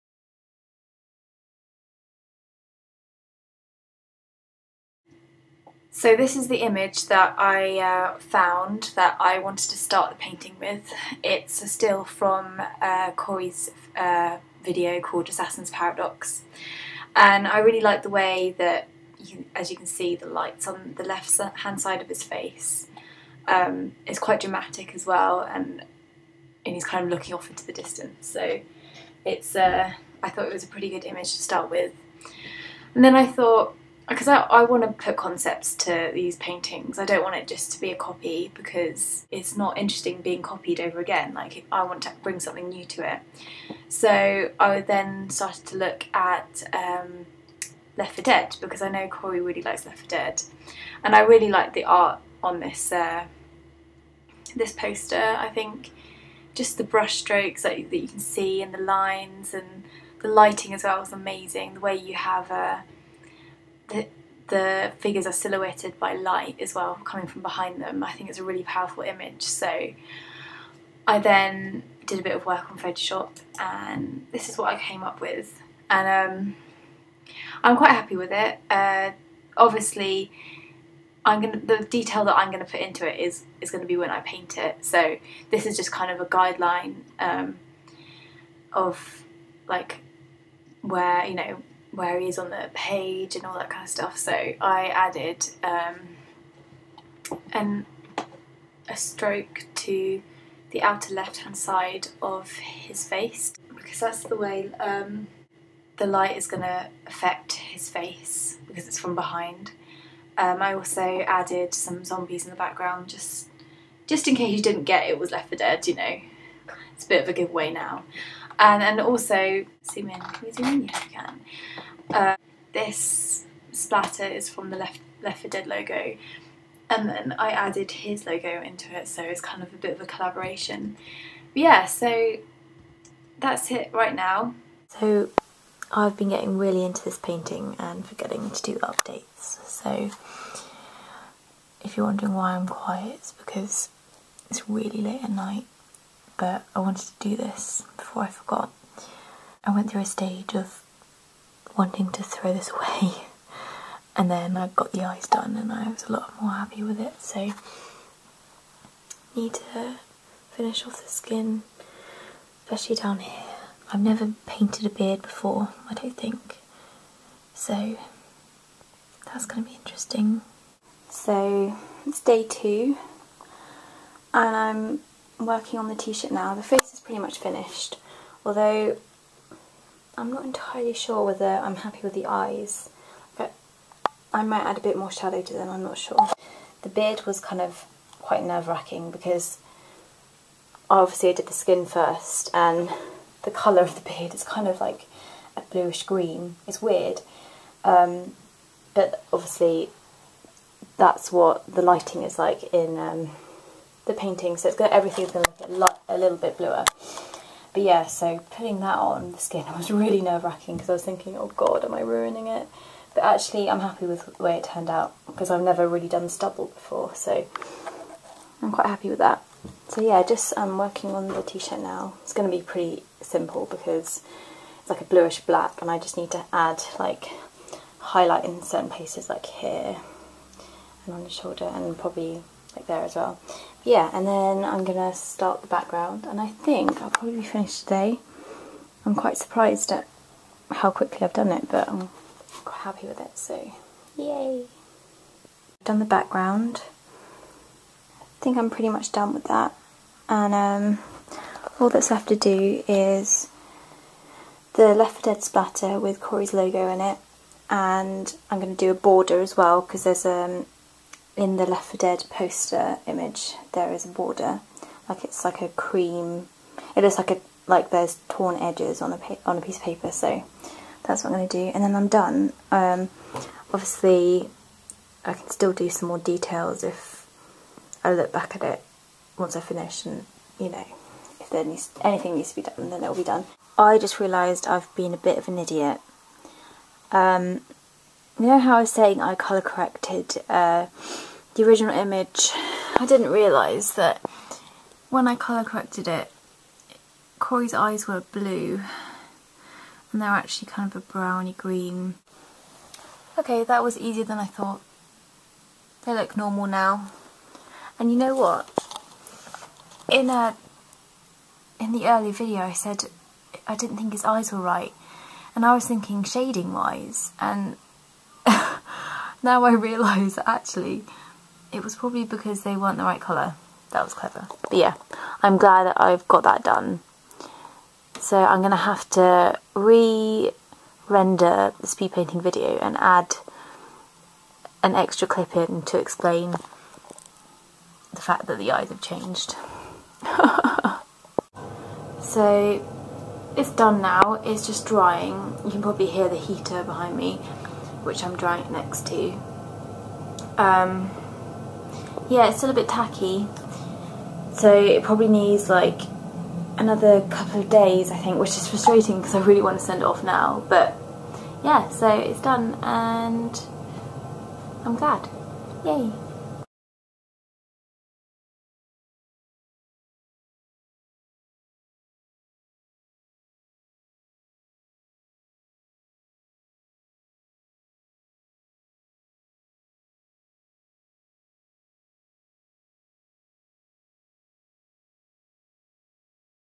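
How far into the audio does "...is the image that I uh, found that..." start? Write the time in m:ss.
0:06.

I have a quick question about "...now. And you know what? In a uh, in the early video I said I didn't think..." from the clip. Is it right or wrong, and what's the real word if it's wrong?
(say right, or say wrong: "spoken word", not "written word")
right.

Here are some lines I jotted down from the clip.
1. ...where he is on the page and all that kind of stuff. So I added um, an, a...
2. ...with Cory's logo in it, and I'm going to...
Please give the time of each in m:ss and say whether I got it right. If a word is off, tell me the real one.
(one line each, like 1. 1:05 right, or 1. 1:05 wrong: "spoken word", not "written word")
1. 1:31 right
2. 4:15 right.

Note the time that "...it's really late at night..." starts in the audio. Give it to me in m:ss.
2:24.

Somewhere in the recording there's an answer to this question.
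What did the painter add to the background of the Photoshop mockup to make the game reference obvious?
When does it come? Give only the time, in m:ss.
1:52.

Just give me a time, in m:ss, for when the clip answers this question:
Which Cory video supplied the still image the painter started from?
0:15.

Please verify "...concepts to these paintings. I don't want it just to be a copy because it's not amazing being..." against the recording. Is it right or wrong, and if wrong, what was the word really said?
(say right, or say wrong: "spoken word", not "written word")
wrong: "interesting", not "amazing".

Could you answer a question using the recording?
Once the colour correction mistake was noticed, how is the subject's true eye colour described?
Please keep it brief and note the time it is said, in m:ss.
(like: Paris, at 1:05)
browny green, at 5:01.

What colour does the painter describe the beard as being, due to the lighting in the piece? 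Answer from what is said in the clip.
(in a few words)
bluish green.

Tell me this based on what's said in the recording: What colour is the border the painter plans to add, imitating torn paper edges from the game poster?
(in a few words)
cream.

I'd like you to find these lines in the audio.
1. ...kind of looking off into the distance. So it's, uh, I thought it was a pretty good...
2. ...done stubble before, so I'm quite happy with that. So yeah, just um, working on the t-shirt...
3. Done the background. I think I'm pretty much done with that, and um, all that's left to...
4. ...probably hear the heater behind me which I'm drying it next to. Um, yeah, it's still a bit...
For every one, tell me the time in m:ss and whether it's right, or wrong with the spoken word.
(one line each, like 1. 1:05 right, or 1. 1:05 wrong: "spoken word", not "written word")
1. 0:26 right
2. 3:36 right
3. 4:05 right
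4. 5:45 right.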